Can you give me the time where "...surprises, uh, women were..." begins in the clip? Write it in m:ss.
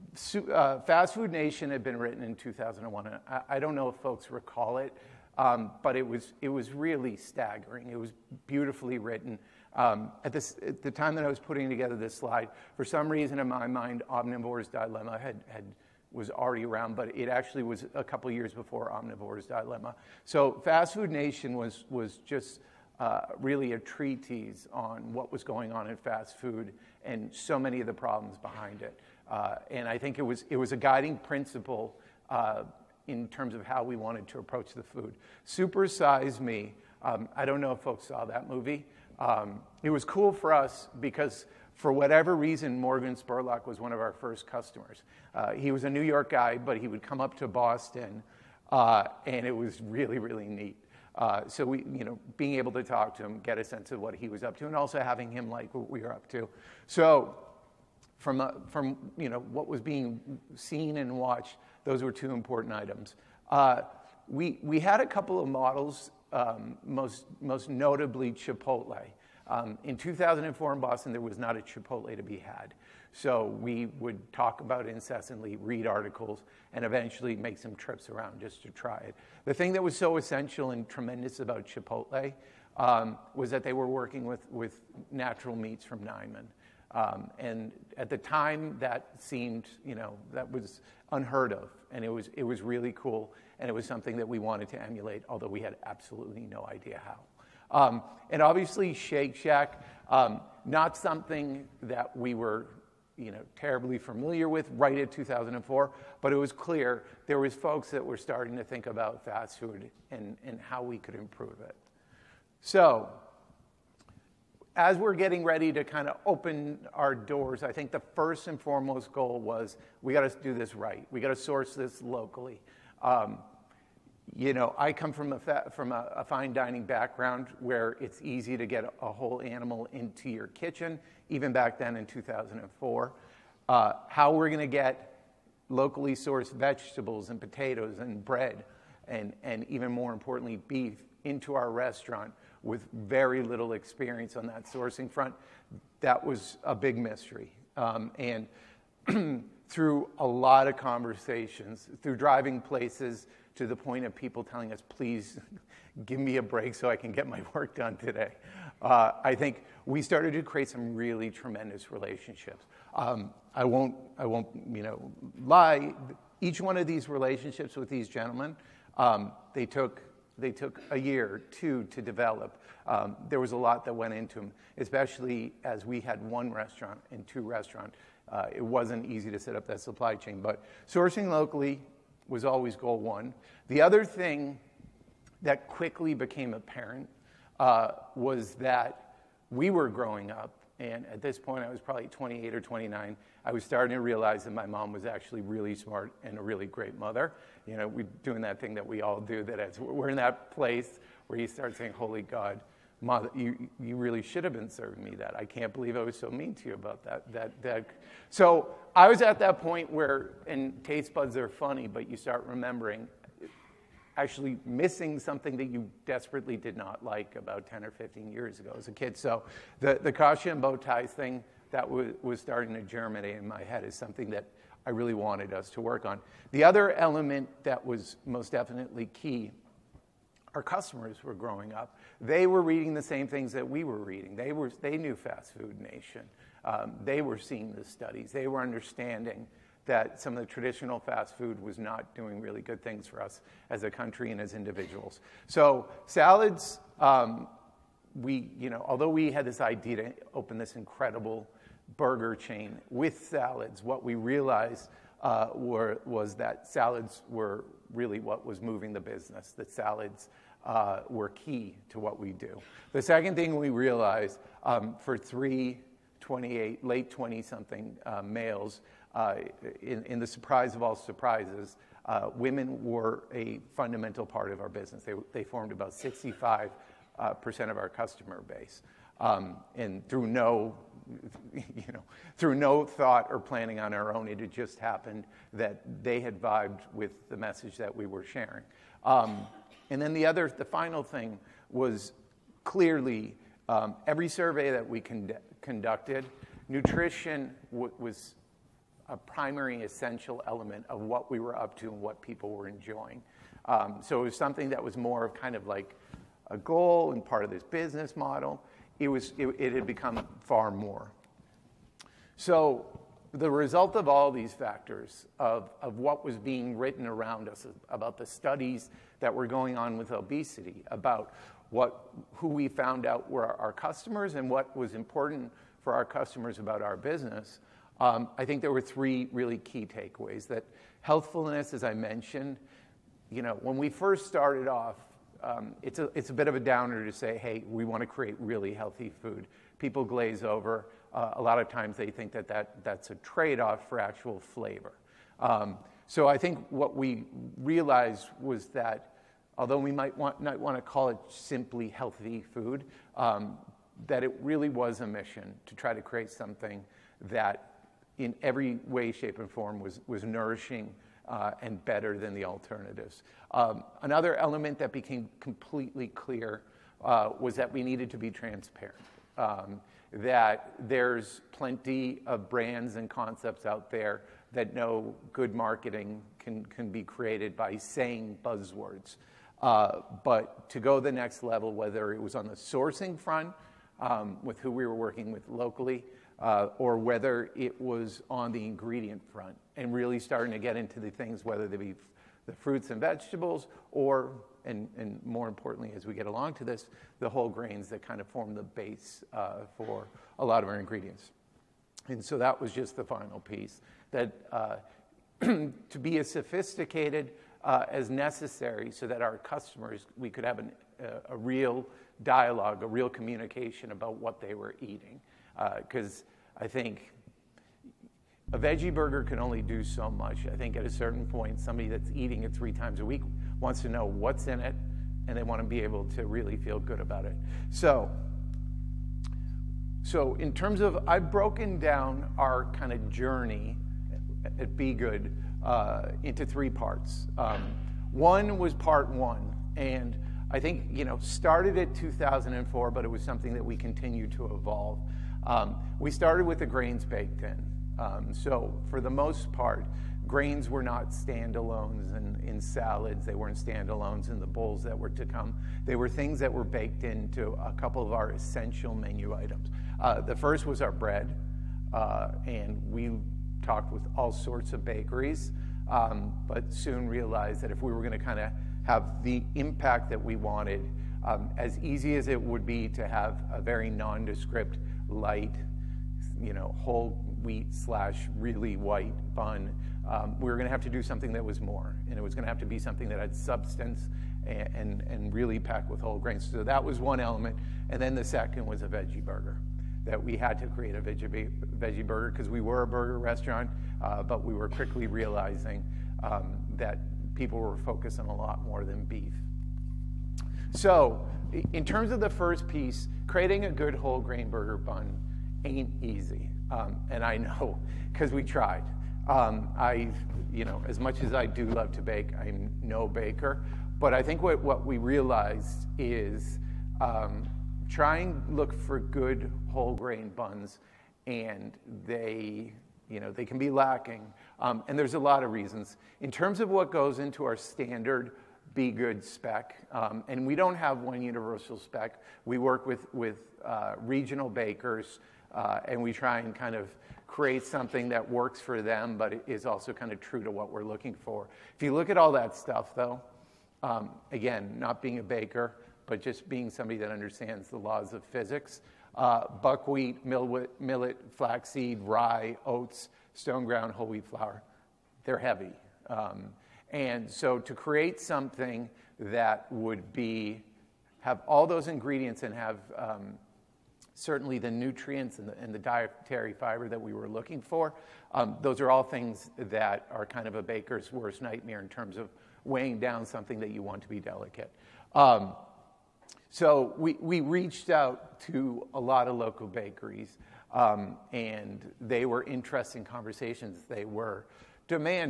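4:30.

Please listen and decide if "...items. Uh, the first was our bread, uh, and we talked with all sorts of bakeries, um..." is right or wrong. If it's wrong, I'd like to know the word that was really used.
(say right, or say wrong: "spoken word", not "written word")
right.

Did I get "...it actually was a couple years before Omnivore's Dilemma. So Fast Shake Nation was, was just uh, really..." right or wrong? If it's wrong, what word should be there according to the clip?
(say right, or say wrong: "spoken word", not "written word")
wrong: "Food", not "Shake".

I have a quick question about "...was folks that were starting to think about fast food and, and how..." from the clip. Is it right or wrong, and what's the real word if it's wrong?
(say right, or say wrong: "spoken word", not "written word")
right.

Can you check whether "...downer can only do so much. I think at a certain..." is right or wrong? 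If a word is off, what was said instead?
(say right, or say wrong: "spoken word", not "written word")
wrong: "burger", not "downer".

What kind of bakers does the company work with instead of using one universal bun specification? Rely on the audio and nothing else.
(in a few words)
regional bakers.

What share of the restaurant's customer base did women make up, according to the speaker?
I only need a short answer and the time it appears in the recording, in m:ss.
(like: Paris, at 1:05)
65%, at 4:35.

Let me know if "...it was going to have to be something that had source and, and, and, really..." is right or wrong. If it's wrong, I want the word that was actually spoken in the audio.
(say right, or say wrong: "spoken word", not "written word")
wrong: "substance", not "source".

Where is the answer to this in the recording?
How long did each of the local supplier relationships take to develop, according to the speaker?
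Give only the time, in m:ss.
2:50.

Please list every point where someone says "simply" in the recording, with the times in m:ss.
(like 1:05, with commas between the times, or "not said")
5:51.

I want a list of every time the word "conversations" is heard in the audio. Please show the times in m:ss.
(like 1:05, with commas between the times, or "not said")
2:30, 9:43.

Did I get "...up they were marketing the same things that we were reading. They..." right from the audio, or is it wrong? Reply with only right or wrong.
wrong.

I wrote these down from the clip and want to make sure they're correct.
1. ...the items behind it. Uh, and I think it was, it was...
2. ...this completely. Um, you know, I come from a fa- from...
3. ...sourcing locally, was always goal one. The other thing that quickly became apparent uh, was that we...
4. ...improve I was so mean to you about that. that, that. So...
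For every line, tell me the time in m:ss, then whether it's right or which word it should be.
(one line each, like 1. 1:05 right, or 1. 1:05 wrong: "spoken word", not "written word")
1. 0:27 wrong: "problems", not "items"
2. 2:01 wrong: "locally", not "completely"
3. 3:00 right
4. 3:25 wrong: "believe", not "improve".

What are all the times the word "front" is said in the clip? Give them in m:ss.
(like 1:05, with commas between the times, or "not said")
2:25, 6:23, 6:29.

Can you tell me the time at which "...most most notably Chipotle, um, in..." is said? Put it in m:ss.
1:06.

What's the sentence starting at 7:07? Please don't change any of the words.
So, so in terms of, I've broken down our kind of journey at b.good uh, into three parts.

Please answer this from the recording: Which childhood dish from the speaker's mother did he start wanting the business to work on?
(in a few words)
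kasha and bow ties.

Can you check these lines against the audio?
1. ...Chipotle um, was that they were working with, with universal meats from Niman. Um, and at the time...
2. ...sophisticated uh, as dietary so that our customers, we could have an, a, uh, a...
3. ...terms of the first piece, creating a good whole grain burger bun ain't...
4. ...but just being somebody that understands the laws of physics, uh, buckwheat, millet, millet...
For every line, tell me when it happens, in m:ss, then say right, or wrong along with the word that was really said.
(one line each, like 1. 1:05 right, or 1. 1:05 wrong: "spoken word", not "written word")
1. 1:21 wrong: "natural", not "universal"
2. 6:46 wrong: "necessary", not "dietary"
3. 8:21 right
4. 9:06 right.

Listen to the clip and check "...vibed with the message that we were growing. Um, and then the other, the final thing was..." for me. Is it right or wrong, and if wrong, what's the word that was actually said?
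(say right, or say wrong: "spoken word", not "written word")
wrong: "sharing", not "growing".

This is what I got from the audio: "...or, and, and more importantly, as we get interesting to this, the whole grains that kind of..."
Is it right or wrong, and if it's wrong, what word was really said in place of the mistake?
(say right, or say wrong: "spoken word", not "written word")
wrong: "along", not "interesting".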